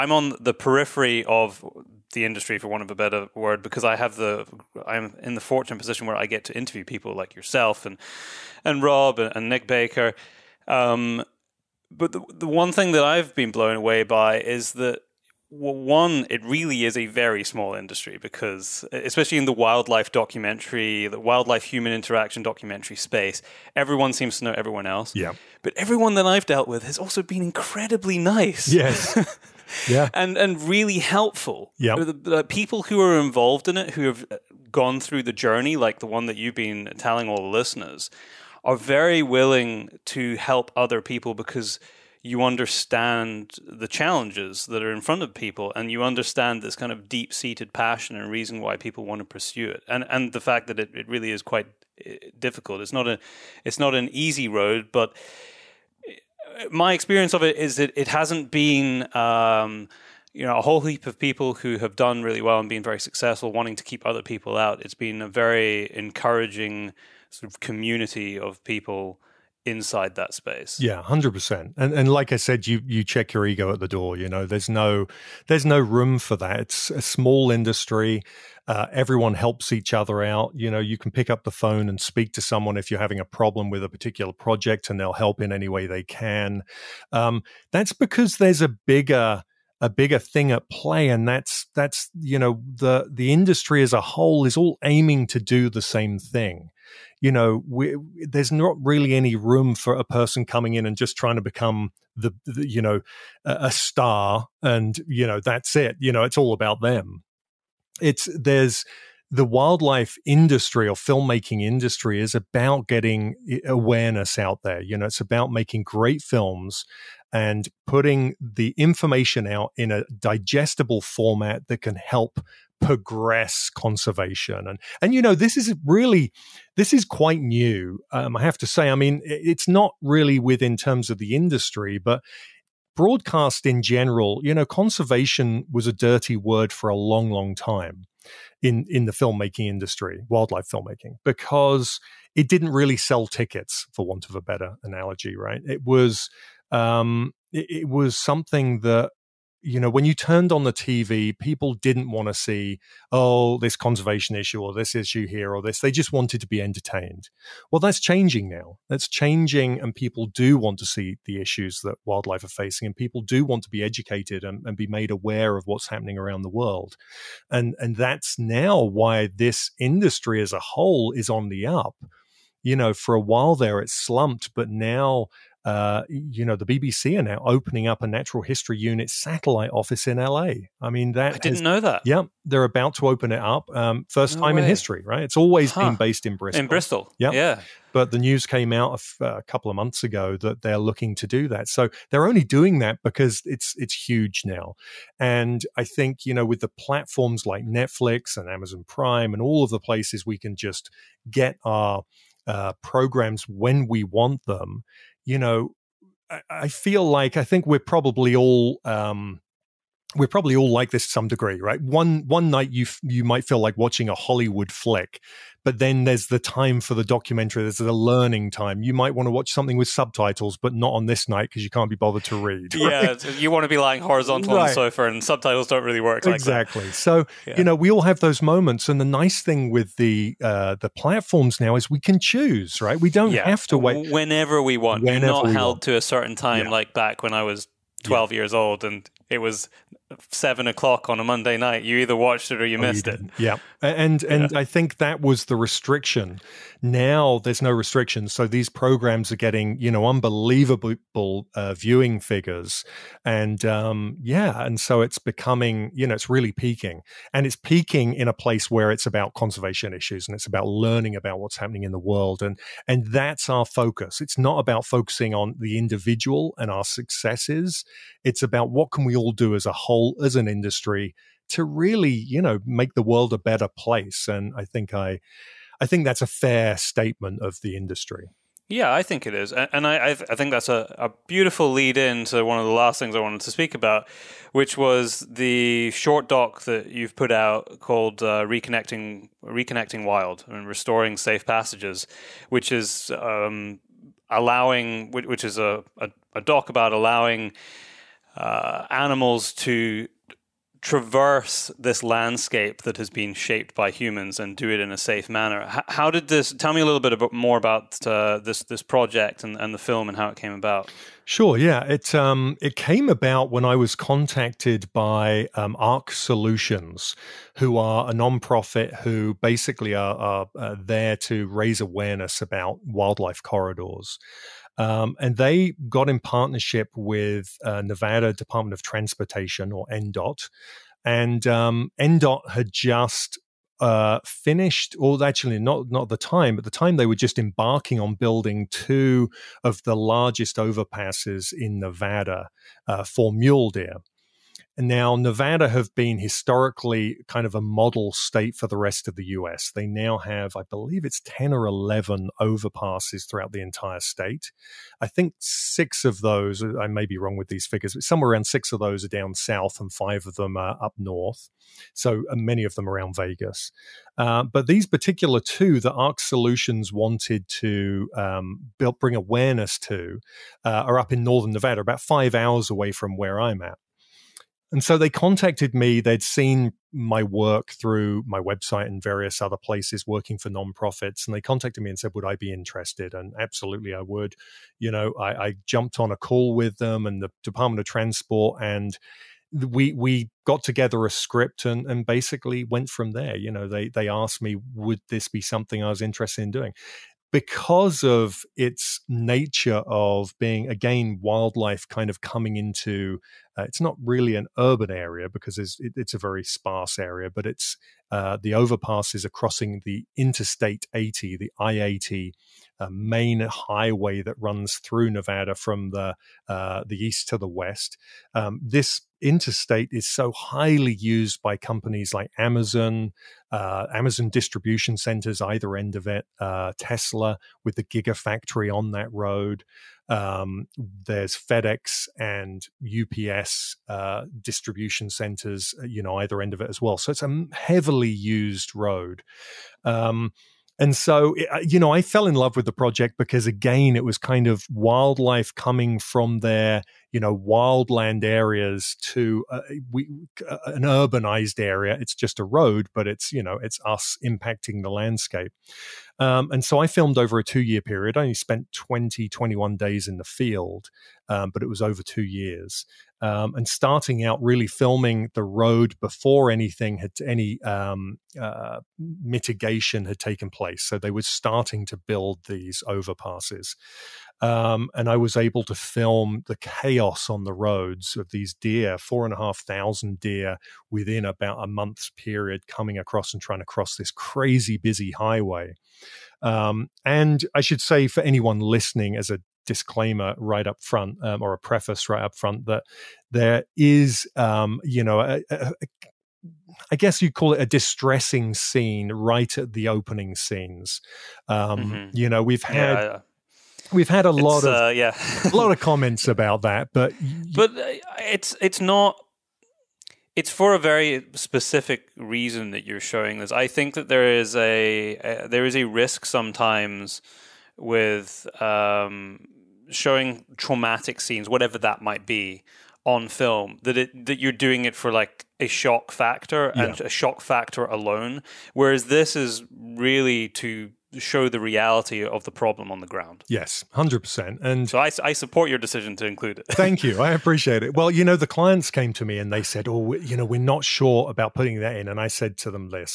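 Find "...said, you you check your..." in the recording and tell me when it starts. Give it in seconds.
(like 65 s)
72 s.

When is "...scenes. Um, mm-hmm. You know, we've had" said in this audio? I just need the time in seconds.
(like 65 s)
500 s.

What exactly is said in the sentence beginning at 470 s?
So they were starting to build these overpasses.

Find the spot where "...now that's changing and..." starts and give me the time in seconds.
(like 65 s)
158 s.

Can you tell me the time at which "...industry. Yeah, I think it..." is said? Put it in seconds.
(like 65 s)
277 s.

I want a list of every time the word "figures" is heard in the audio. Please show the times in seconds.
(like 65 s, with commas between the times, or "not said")
252 s, 357 s.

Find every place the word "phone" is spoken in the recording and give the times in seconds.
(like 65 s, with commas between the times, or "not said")
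81 s.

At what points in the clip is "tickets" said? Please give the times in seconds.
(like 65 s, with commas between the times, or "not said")
143 s.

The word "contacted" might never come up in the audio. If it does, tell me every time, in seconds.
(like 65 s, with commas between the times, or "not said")
313 s, 375 s, 381 s.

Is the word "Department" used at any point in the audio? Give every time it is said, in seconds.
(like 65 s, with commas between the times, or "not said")
328 s, 387 s.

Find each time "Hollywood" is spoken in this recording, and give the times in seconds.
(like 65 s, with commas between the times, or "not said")
214 s.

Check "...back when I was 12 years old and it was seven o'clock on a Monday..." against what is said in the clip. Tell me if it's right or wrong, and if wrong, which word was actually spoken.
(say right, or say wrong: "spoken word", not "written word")
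right.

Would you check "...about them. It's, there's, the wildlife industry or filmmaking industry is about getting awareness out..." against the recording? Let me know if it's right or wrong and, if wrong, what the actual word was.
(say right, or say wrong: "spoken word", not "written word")
right.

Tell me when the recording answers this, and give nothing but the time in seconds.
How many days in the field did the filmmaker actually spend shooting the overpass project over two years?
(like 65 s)
459 s.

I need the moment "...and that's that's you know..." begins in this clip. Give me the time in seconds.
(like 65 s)
91 s.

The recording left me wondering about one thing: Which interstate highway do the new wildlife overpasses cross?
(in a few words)
I-80.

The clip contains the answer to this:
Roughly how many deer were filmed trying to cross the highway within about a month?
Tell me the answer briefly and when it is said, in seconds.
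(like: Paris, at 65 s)
4,500, at 478 s.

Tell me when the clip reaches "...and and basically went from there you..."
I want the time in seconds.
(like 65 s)
391 s.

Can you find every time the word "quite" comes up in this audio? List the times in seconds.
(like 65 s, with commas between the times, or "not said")
51 s, 127 s.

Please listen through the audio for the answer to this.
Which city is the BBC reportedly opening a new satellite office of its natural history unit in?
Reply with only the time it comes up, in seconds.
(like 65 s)
180 s.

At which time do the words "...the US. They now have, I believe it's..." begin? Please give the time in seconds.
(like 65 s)
349 s.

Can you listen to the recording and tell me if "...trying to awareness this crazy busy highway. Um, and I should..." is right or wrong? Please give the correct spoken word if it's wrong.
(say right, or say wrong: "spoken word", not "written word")
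wrong: "cross", not "awareness".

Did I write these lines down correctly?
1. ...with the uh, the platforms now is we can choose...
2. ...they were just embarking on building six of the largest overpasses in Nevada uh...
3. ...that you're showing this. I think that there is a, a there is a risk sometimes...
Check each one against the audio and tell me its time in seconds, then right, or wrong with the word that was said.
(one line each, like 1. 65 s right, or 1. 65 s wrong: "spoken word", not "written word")
1. 229 s right
2. 336 s wrong: "two", not "six"
3. 512 s right.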